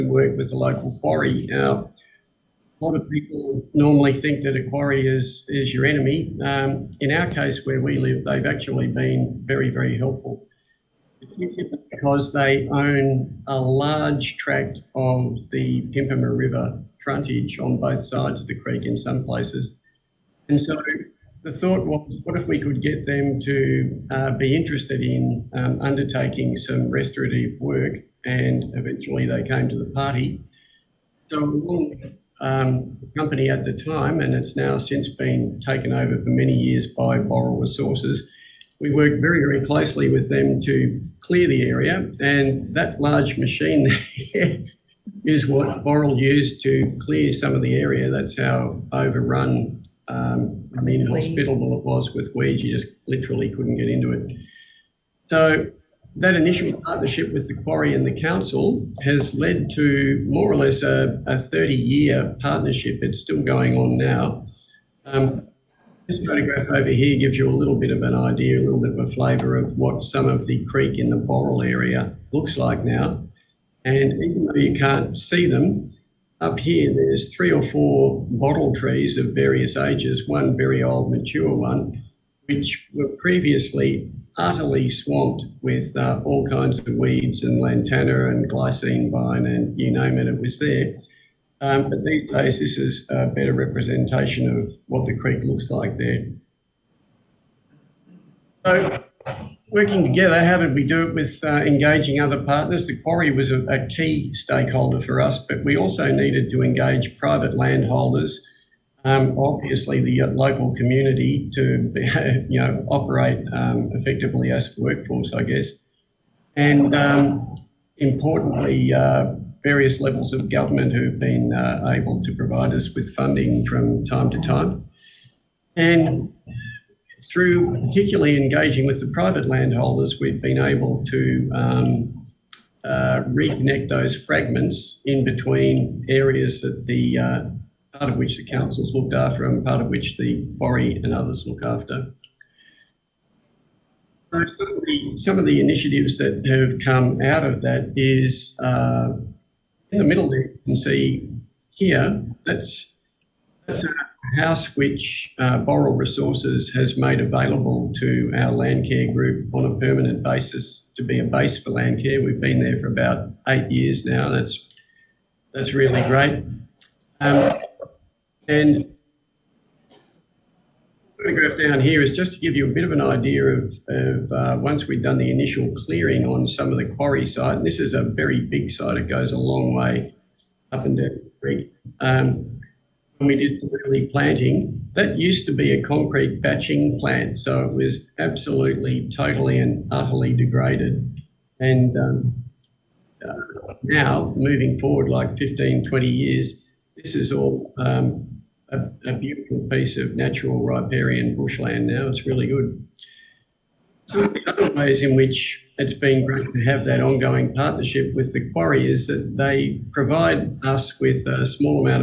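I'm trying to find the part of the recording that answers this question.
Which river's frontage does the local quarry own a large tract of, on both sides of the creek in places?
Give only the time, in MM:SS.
00:15.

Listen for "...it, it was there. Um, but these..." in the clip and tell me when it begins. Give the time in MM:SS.
01:30.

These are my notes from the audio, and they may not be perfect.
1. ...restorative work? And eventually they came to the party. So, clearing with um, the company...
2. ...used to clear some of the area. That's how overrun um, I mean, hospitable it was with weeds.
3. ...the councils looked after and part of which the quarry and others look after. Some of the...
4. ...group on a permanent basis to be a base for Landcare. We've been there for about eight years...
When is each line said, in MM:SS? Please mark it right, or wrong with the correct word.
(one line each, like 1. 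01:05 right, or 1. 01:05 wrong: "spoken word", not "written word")
1. 00:26 wrong: "along", not "clearing"
2. 00:46 right
3. 02:18 right
4. 02:39 right.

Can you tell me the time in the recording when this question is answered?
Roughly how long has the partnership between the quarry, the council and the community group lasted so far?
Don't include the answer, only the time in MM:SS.
01:01.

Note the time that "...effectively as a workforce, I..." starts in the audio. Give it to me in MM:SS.
01:53.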